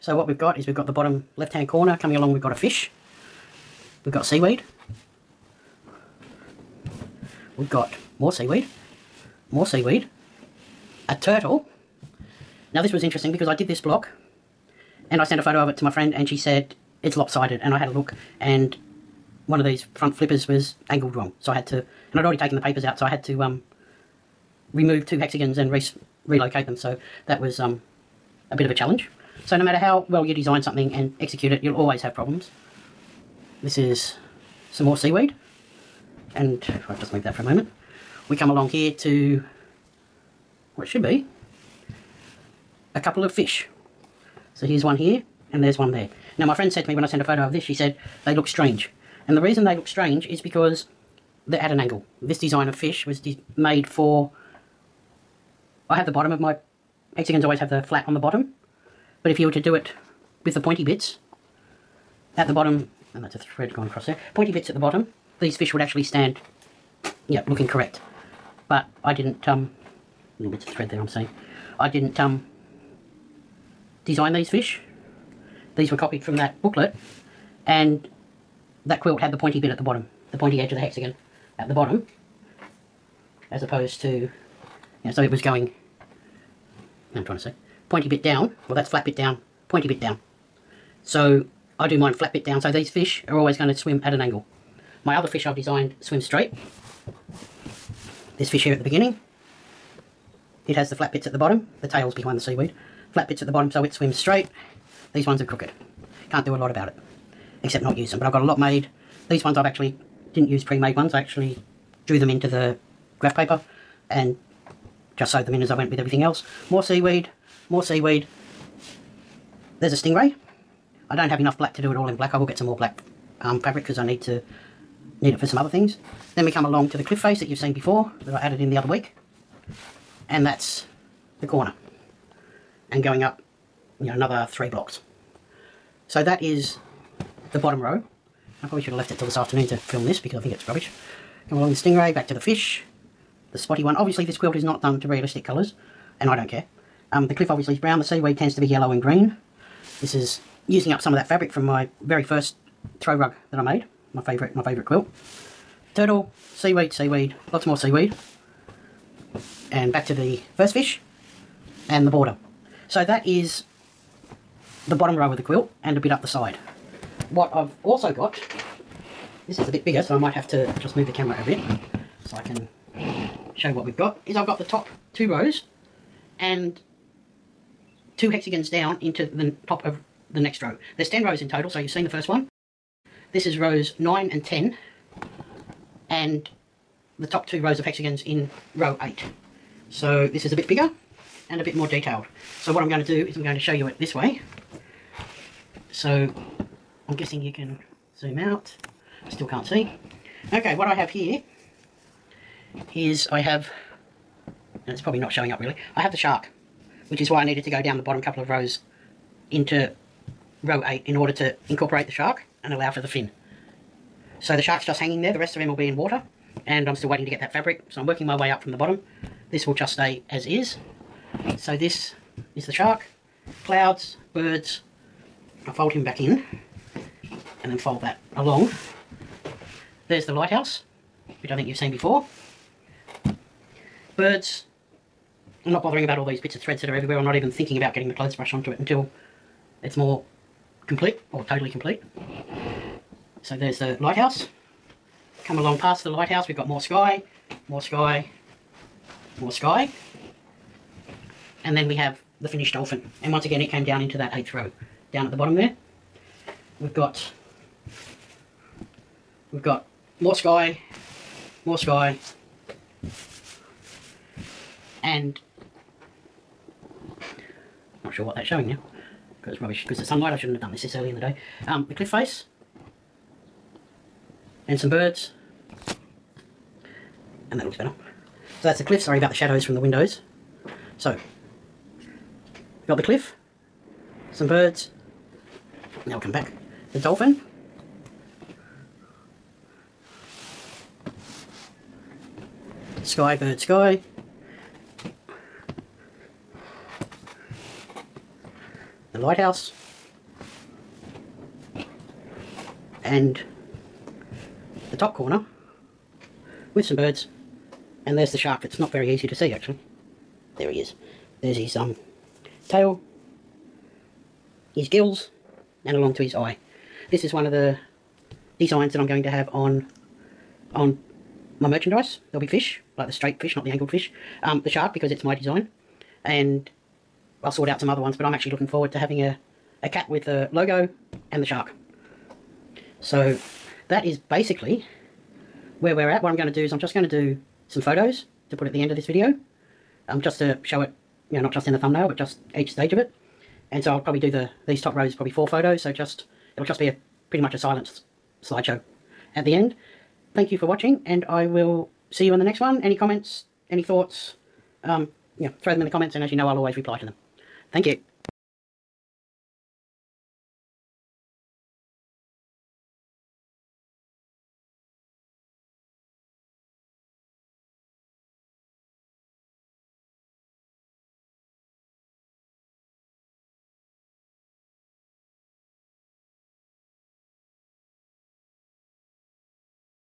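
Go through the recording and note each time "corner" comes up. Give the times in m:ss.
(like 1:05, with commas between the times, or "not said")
0:01, 2:11, 5:05.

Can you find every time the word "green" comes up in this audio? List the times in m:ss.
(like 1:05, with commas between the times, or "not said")
2:28.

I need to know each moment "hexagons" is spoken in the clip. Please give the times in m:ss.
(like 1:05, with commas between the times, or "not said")
0:25, 0:57, 1:20, 2:58, 3:07.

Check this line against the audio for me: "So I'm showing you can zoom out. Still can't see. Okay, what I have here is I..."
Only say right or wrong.
wrong.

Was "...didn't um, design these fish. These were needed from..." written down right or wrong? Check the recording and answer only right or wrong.
wrong.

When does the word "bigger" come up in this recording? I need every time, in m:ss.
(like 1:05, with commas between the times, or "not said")
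2:49, 3:10.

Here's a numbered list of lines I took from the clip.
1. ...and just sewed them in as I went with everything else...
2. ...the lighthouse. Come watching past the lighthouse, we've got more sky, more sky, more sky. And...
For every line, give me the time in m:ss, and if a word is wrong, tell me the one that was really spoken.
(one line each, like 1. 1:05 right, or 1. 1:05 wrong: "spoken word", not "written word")
1. 1:54 right
2. 4:03 wrong: "along", not "watching".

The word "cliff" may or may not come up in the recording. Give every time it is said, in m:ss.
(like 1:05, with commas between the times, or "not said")
2:07, 2:27, 4:31, 4:38, 4:43.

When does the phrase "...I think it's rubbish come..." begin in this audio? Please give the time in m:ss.
2:20.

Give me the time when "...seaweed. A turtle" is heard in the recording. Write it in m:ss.
0:09.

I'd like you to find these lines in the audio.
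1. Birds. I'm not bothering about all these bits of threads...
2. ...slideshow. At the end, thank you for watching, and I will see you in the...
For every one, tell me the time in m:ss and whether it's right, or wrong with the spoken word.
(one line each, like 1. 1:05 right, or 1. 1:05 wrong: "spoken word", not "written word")
1. 3:54 right
2. 5:48 right.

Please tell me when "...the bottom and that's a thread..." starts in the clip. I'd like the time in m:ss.
1:02.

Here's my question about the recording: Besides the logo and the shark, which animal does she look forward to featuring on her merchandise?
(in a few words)
Cat.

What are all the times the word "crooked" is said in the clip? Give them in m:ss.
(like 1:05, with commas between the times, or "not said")
1:45.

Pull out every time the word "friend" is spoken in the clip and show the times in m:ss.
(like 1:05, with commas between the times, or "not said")
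0:15, 0:46.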